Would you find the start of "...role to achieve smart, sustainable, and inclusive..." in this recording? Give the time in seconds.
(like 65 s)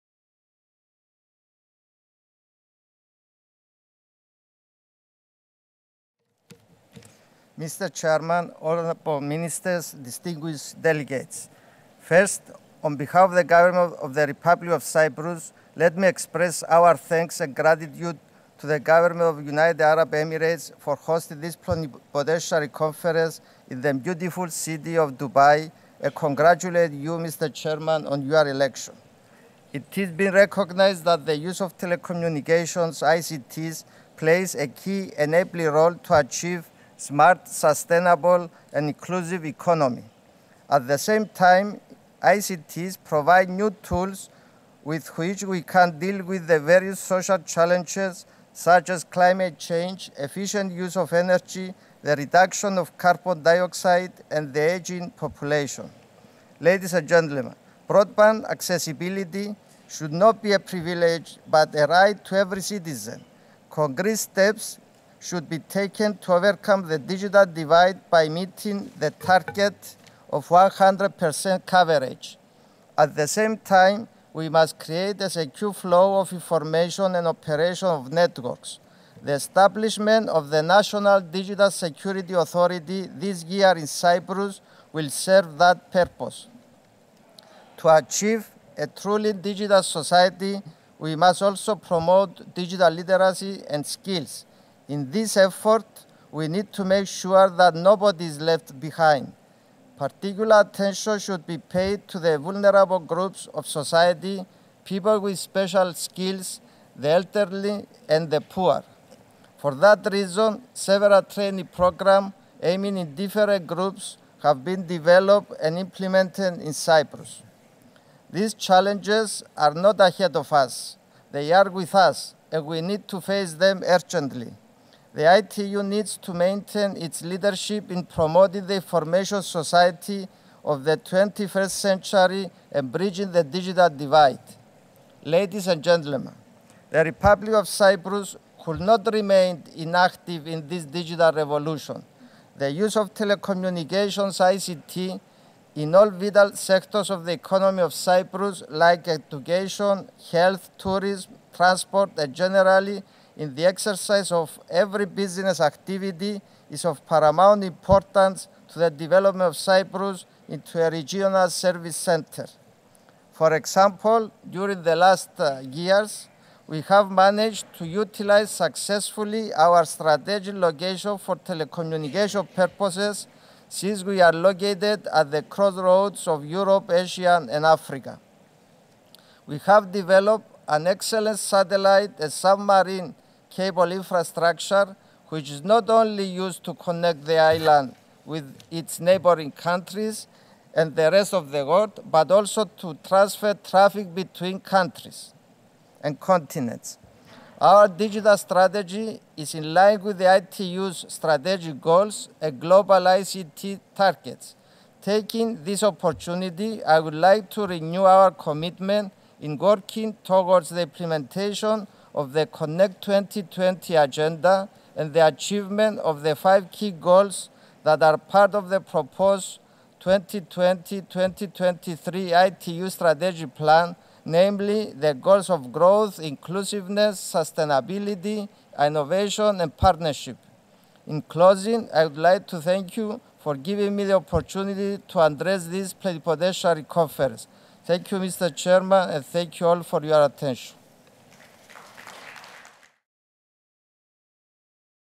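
35 s.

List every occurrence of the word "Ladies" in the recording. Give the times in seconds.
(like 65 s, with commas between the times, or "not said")
56 s, 135 s.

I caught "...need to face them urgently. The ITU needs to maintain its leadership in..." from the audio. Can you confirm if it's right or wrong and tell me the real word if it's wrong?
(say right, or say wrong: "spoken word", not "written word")
right.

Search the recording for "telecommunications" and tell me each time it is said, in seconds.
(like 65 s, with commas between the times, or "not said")
31 s, 143 s, 171 s.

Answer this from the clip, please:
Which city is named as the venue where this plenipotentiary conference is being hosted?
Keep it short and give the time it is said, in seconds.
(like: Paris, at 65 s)
Dubai, at 25 s.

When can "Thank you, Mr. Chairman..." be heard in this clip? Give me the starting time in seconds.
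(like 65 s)
237 s.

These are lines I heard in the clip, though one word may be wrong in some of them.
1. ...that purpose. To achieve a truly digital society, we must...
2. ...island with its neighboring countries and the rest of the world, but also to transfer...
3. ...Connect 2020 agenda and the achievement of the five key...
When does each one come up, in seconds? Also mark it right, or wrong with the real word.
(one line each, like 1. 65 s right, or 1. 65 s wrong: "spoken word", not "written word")
1. 85 s right
2. 187 s right
3. 212 s right.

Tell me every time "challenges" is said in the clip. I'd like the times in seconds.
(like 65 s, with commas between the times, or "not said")
47 s, 118 s.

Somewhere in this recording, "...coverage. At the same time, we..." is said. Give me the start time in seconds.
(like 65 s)
71 s.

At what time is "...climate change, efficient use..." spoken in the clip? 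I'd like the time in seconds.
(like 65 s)
49 s.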